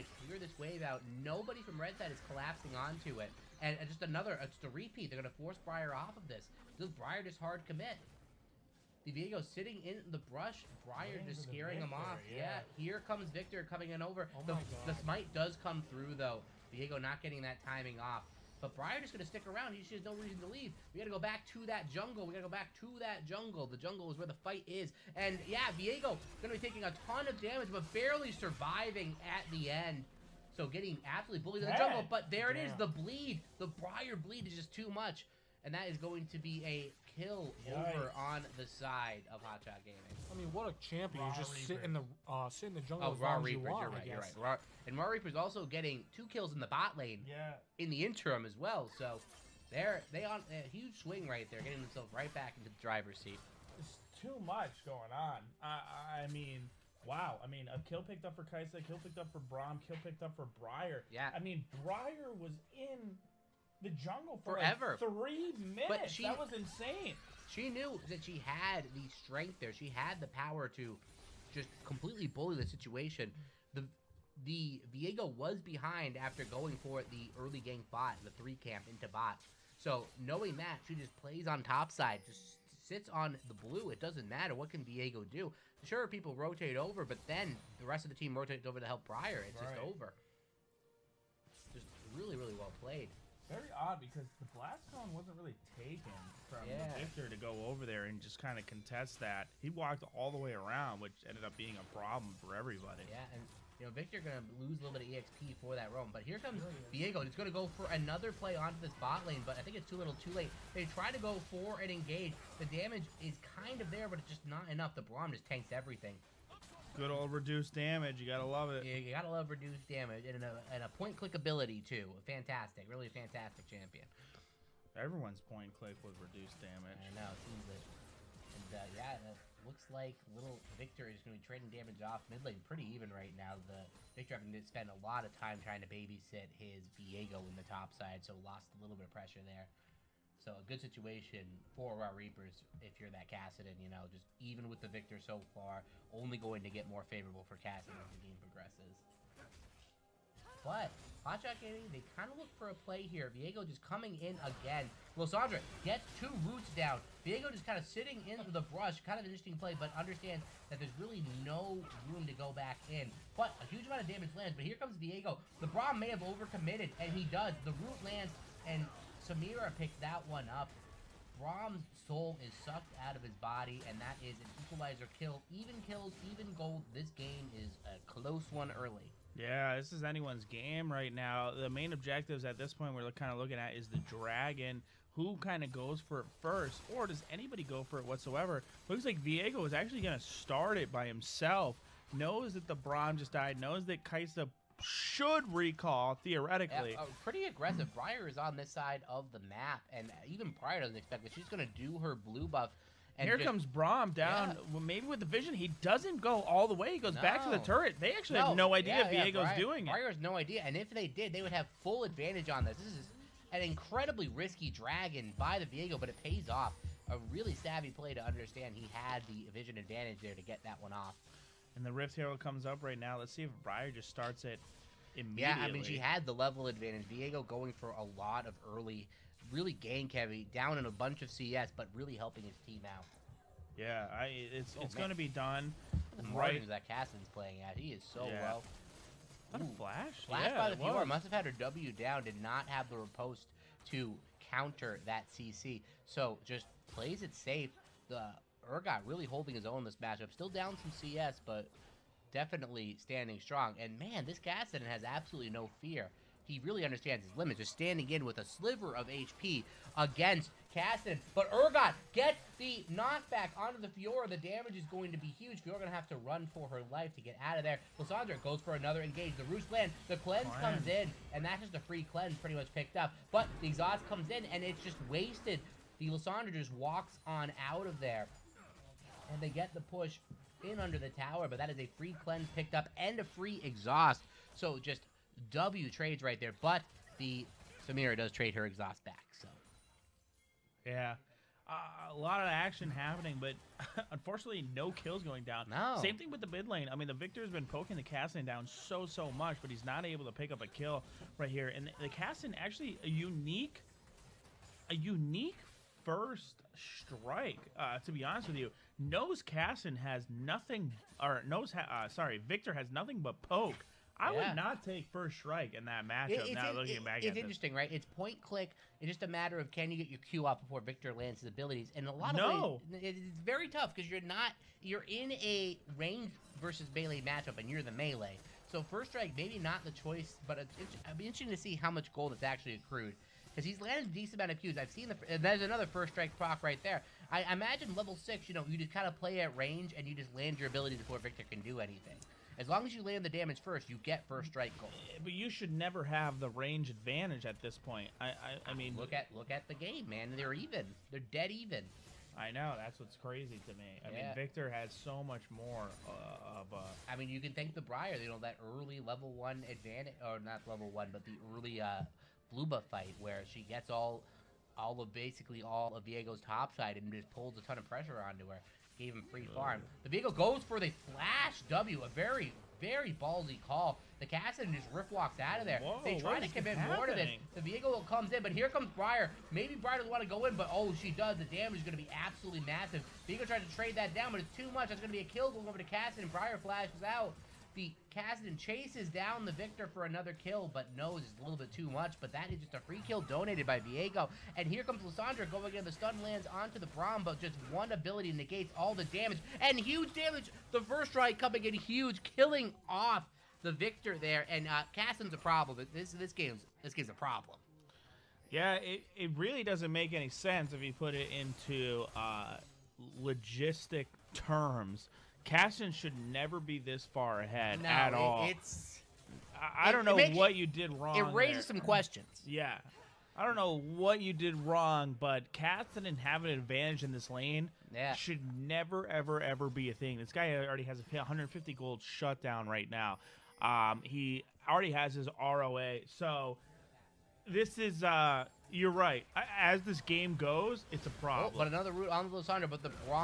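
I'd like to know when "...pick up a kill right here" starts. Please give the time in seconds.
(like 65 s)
300 s.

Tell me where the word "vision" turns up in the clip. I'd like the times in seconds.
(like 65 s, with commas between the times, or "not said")
205 s, 219 s.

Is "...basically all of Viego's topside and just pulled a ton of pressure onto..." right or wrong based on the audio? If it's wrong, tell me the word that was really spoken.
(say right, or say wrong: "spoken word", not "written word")
right.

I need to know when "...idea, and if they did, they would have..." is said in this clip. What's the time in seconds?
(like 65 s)
210 s.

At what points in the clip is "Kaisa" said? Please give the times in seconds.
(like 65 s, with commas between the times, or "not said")
58 s, 194 s.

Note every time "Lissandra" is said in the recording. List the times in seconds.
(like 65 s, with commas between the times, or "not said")
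155 s, 267 s, 276 s, 395 s, 442 s.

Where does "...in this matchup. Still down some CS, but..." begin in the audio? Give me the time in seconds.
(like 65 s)
249 s.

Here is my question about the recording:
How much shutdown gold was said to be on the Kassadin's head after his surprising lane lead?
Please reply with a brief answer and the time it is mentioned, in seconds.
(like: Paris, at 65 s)
150 gold, at 431 s.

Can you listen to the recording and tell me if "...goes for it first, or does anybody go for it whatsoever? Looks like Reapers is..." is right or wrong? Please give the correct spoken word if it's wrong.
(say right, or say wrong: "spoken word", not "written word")
wrong: "Viego", not "Reapers".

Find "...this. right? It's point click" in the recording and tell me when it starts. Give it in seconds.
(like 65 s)
317 s.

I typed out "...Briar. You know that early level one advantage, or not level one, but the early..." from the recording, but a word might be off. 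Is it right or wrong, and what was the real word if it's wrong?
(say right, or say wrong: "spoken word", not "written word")
right.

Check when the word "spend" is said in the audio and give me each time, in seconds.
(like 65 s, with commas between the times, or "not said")
134 s.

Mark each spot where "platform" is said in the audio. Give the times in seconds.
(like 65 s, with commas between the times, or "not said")
not said.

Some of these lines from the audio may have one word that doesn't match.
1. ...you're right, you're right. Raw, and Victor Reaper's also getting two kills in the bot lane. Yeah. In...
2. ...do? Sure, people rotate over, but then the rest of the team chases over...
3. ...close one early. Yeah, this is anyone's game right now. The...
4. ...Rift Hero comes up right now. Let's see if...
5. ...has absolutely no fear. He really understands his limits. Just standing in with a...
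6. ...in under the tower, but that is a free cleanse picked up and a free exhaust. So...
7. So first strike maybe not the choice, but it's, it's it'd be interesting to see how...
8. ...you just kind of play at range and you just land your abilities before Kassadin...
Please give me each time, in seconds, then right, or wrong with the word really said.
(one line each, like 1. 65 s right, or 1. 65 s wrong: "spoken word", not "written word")
1. 43 s wrong: "Rawr", not "Victor"
2. 85 s wrong: "rotates", not "chases"
3. 178 s right
4. 221 s right
5. 254 s right
6. 280 s right
7. 328 s right
8. 338 s wrong: "Victor", not "Kassadin".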